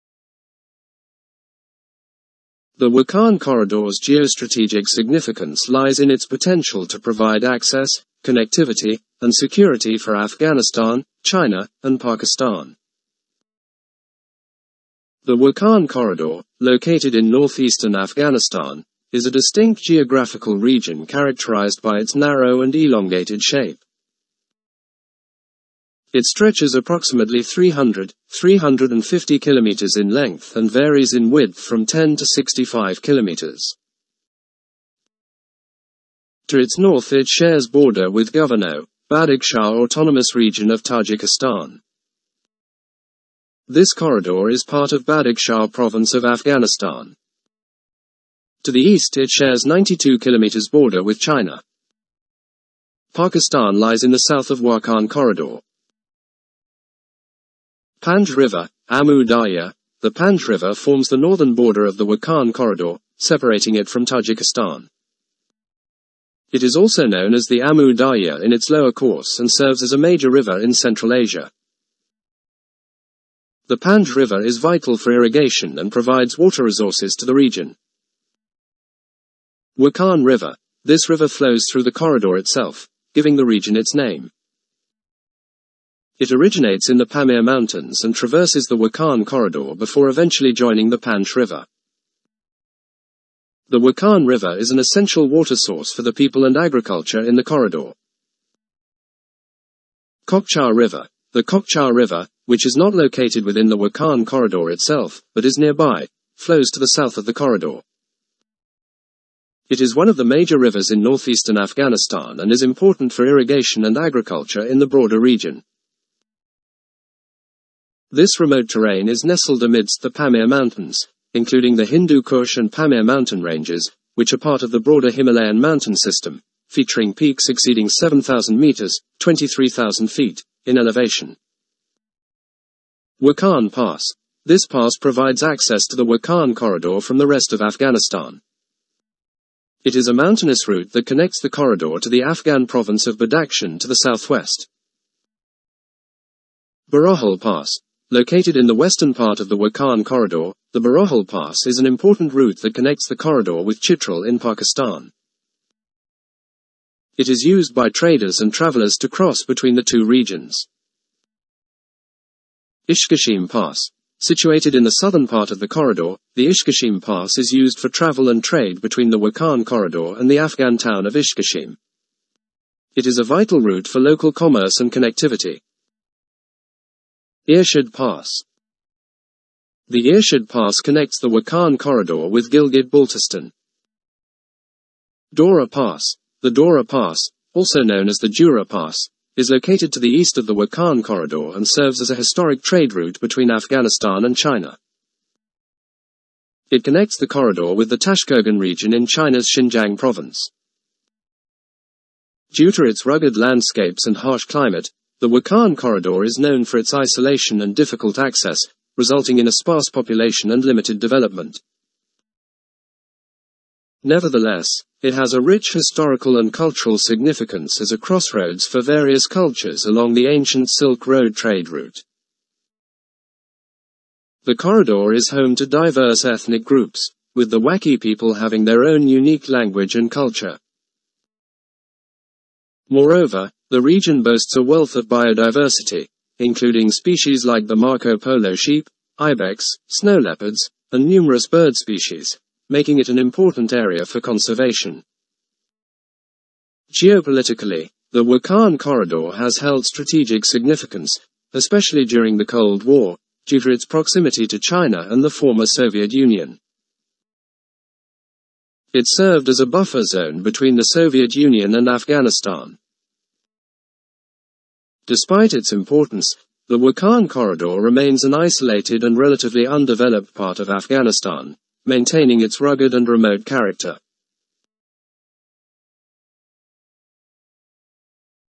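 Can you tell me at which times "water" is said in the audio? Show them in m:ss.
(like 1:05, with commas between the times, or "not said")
1:16, 1:35.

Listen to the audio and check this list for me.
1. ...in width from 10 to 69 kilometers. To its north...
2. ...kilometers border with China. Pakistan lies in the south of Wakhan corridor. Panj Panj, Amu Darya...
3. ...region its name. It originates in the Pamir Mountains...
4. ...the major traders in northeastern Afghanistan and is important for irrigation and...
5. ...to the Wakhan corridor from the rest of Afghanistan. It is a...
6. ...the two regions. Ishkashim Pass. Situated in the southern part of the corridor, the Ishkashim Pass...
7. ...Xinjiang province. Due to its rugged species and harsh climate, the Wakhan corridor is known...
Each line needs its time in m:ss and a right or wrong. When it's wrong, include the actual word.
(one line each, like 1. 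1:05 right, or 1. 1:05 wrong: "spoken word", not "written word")
1. 0:31 wrong: "65", not "69"
2. 0:50 wrong: "River", not "Panj"
3. 1:23 right
4. 1:50 wrong: "rivers", not "traders"
5. 2:15 right
6. 2:39 right
7. 3:19 wrong: "landscapes", not "species".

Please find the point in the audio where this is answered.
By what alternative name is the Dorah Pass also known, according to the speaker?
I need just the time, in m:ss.
3:08.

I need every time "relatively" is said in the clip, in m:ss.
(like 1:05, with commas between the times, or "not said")
4:29.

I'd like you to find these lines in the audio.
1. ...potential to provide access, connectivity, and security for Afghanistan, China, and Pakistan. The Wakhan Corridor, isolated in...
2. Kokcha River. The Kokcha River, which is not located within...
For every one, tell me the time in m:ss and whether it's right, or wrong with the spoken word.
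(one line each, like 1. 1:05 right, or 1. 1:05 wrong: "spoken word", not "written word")
1. 0:06 wrong: "located", not "isolated"
2. 1:40 right.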